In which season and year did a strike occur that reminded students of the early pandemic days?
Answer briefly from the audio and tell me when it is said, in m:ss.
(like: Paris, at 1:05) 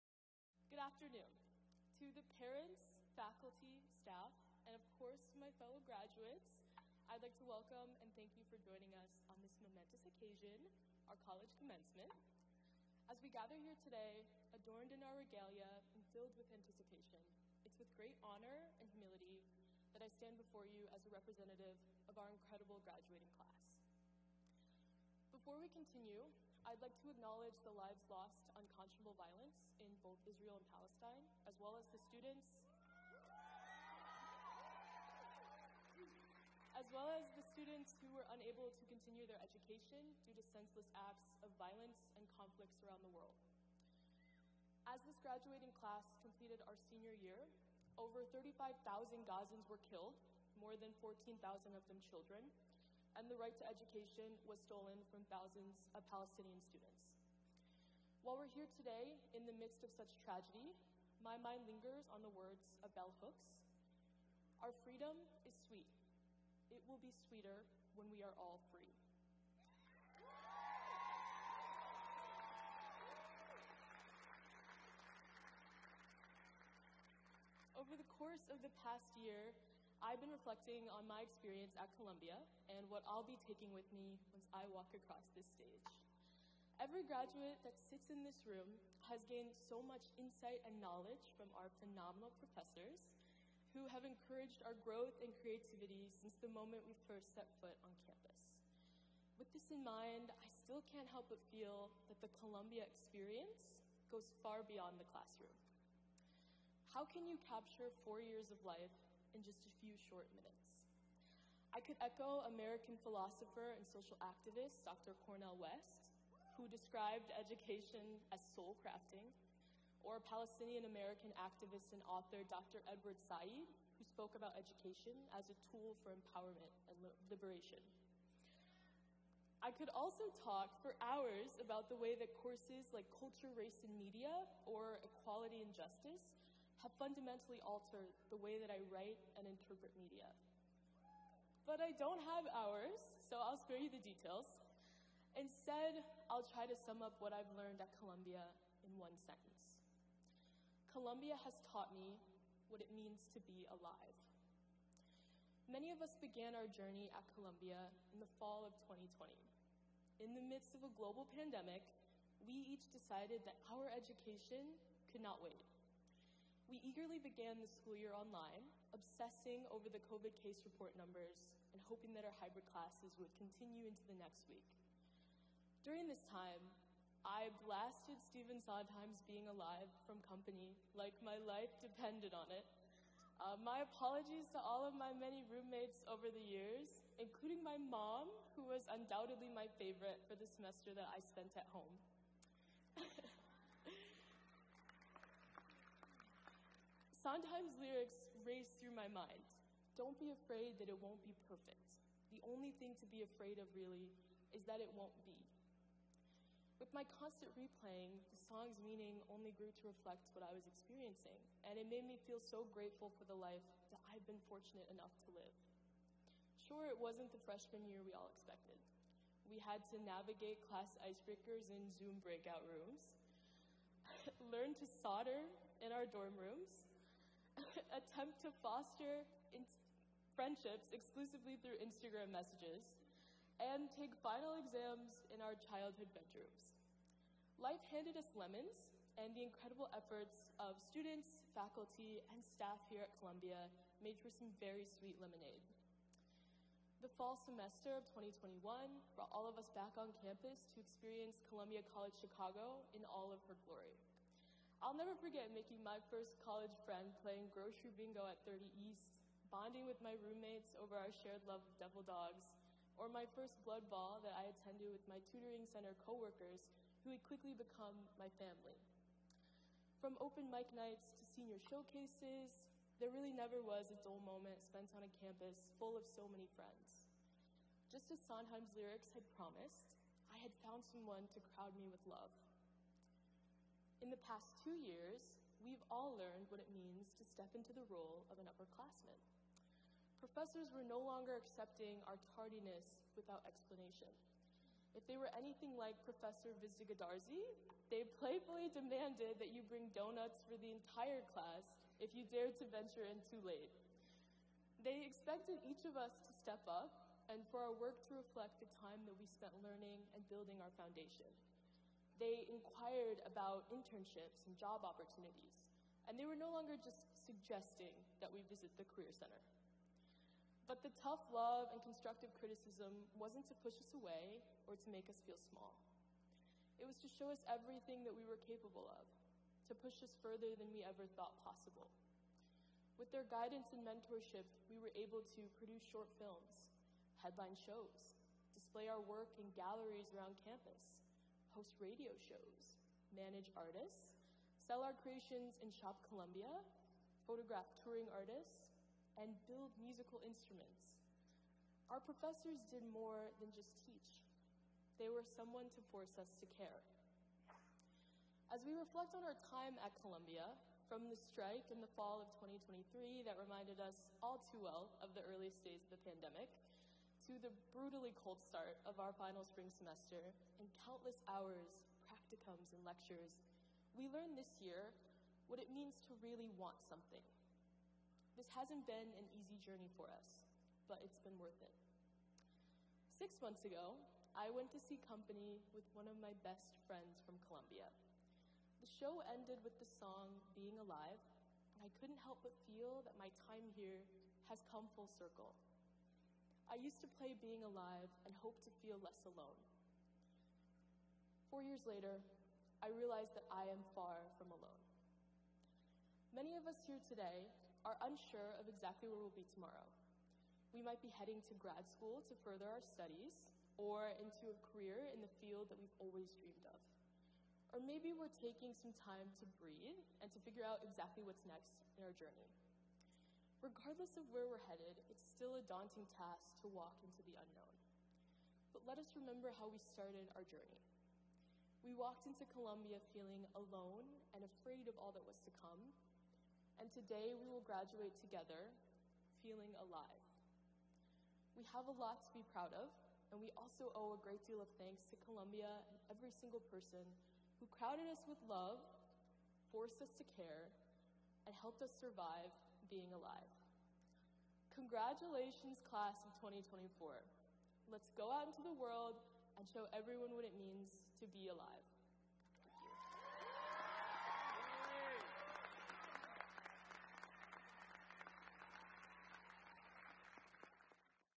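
Fall of 2023, at 6:01.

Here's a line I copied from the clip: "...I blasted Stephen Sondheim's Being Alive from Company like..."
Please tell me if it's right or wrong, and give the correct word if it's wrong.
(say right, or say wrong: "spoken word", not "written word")
right.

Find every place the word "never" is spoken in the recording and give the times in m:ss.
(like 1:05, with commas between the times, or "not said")
4:14, 4:33.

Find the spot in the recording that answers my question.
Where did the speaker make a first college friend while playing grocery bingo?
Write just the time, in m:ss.
4:18.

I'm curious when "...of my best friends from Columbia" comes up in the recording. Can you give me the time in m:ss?
6:26.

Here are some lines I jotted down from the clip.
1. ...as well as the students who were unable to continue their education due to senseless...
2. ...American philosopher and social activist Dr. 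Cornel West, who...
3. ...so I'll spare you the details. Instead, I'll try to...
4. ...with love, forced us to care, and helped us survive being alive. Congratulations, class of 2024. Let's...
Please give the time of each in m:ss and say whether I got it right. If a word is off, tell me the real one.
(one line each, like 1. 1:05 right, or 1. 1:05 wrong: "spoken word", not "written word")
1. 0:36 right
2. 1:52 right
3. 2:23 right
4. 7:28 right.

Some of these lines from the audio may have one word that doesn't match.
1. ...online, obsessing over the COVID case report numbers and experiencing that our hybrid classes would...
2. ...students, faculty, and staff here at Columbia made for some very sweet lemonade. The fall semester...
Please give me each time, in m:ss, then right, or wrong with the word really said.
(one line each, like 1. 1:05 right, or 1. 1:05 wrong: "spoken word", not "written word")
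1. 2:48 wrong: "hoping", not "experiencing"
2. 4:00 right.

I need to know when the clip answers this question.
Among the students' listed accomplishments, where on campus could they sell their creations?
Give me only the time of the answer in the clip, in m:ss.
5:45.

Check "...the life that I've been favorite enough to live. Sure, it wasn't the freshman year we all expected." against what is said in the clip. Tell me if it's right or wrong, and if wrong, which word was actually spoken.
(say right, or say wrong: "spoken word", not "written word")
wrong: "fortunate", not "favorite".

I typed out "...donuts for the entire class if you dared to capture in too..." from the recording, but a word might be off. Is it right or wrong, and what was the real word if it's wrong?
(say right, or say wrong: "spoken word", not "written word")
wrong: "venture", not "capture".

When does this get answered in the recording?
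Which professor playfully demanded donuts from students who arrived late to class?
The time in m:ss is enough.
4:56.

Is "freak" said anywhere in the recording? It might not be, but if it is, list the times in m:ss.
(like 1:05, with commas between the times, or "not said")
not said.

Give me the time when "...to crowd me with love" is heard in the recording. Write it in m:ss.
4:41.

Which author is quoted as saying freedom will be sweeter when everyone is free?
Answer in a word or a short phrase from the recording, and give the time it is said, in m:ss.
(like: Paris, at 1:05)
bell hooks, at 1:02.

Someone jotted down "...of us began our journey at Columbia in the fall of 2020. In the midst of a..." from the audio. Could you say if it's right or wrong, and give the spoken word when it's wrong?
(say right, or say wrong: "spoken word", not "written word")
right.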